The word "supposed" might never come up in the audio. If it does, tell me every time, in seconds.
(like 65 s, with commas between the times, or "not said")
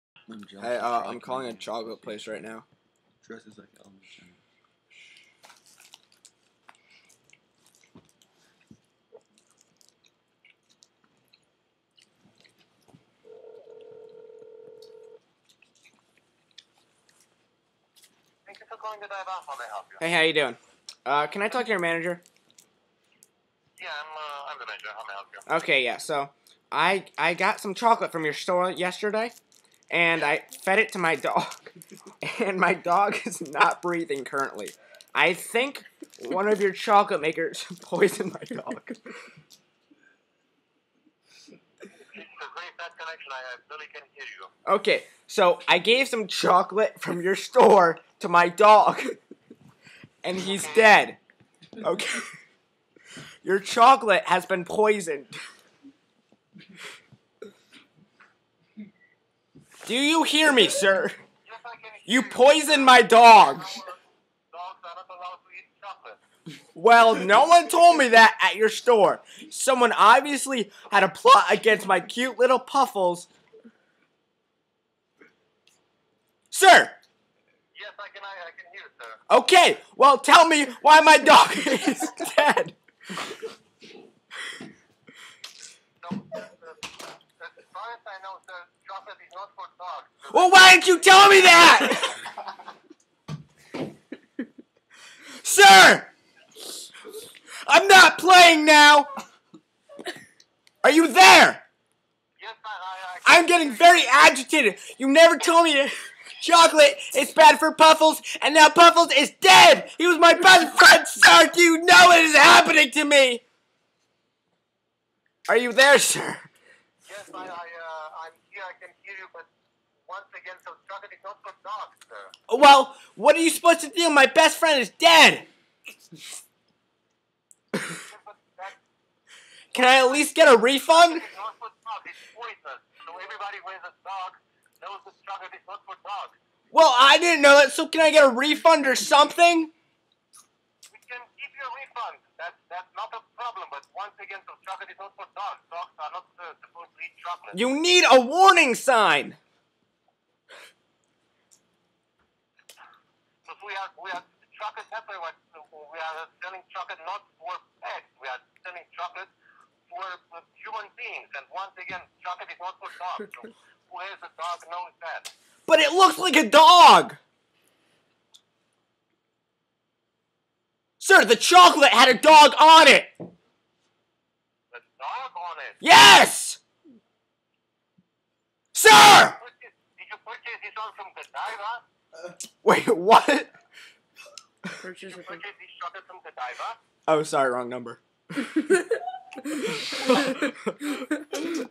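123 s, 146 s.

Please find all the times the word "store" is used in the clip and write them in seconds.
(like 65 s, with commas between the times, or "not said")
28 s, 47 s, 68 s.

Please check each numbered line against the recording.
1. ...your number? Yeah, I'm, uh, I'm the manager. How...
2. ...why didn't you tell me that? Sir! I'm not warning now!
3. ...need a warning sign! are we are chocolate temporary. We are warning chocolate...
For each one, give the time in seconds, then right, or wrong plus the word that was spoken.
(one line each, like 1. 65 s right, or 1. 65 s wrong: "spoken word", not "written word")
1. 21 s wrong: "manager", not "number"
2. 90 s wrong: "playing", not "warning"
3. 147 s wrong: "selling", not "warning".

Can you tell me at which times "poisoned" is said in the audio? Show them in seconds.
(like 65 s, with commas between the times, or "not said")
37 s, 54 s, 62 s.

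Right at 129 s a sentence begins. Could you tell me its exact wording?
Can I at least get a refund?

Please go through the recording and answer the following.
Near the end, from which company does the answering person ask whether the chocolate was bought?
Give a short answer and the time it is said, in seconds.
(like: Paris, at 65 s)
Godiva, at 181 s.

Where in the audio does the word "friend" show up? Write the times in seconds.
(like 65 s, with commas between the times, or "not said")
110 s, 124 s.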